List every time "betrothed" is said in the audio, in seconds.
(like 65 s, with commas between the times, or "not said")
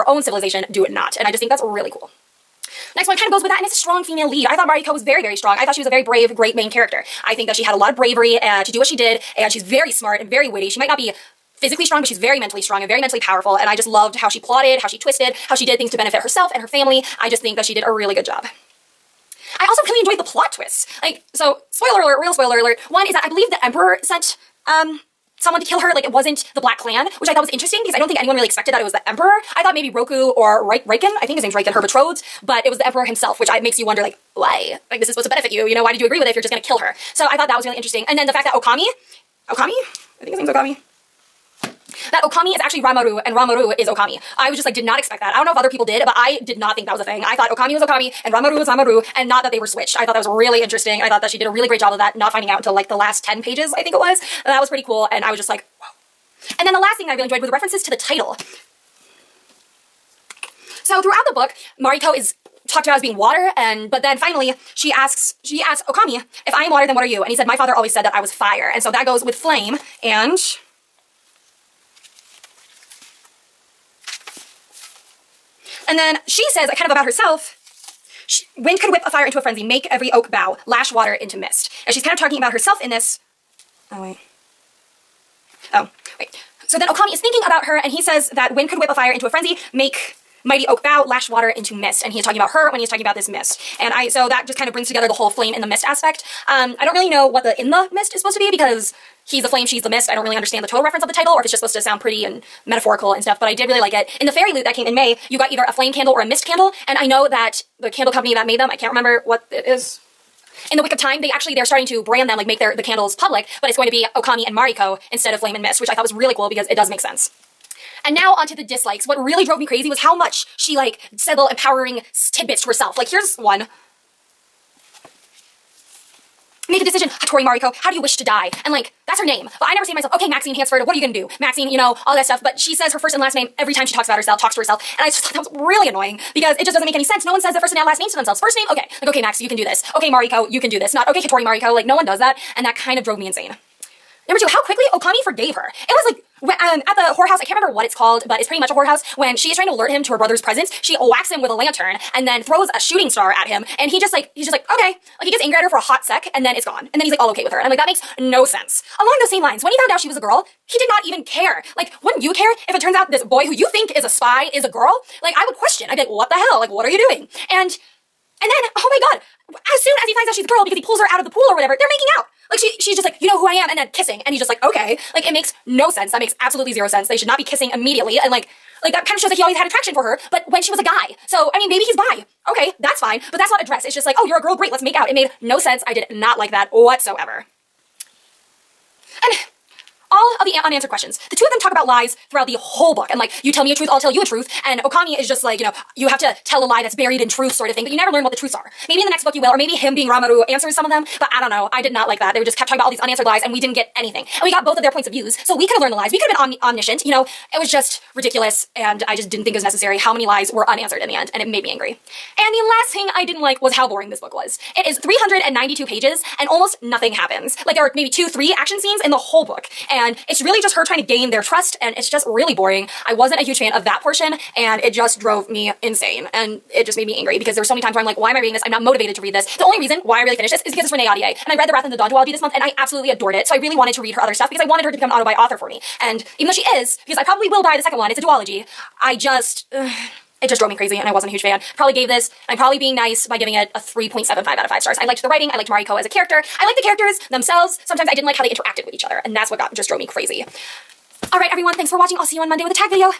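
31 s.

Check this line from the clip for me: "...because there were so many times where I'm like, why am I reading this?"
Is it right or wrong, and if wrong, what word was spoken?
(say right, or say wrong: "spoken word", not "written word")
right.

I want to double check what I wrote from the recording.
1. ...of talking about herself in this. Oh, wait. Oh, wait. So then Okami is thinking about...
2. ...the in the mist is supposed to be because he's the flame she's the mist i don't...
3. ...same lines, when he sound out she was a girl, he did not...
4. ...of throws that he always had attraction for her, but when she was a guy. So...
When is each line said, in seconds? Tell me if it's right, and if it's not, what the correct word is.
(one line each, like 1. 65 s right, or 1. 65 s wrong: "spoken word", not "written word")
1. 82 s right
2. 97 s right
3. 159 s wrong: "found", not "sound"
4. 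179 s wrong: "shows", not "throws".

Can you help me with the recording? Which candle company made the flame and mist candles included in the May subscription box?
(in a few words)
In the Wick of Time.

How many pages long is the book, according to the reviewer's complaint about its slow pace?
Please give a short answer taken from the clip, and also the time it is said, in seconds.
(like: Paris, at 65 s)
392, at 214 s.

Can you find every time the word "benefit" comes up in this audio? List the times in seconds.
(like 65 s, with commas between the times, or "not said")
15 s, 35 s.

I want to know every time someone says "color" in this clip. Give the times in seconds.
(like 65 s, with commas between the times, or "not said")
not said.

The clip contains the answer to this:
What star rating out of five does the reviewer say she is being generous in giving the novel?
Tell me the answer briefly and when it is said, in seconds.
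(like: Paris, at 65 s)
3.75, at 243 s.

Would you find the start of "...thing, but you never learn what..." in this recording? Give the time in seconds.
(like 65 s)
197 s.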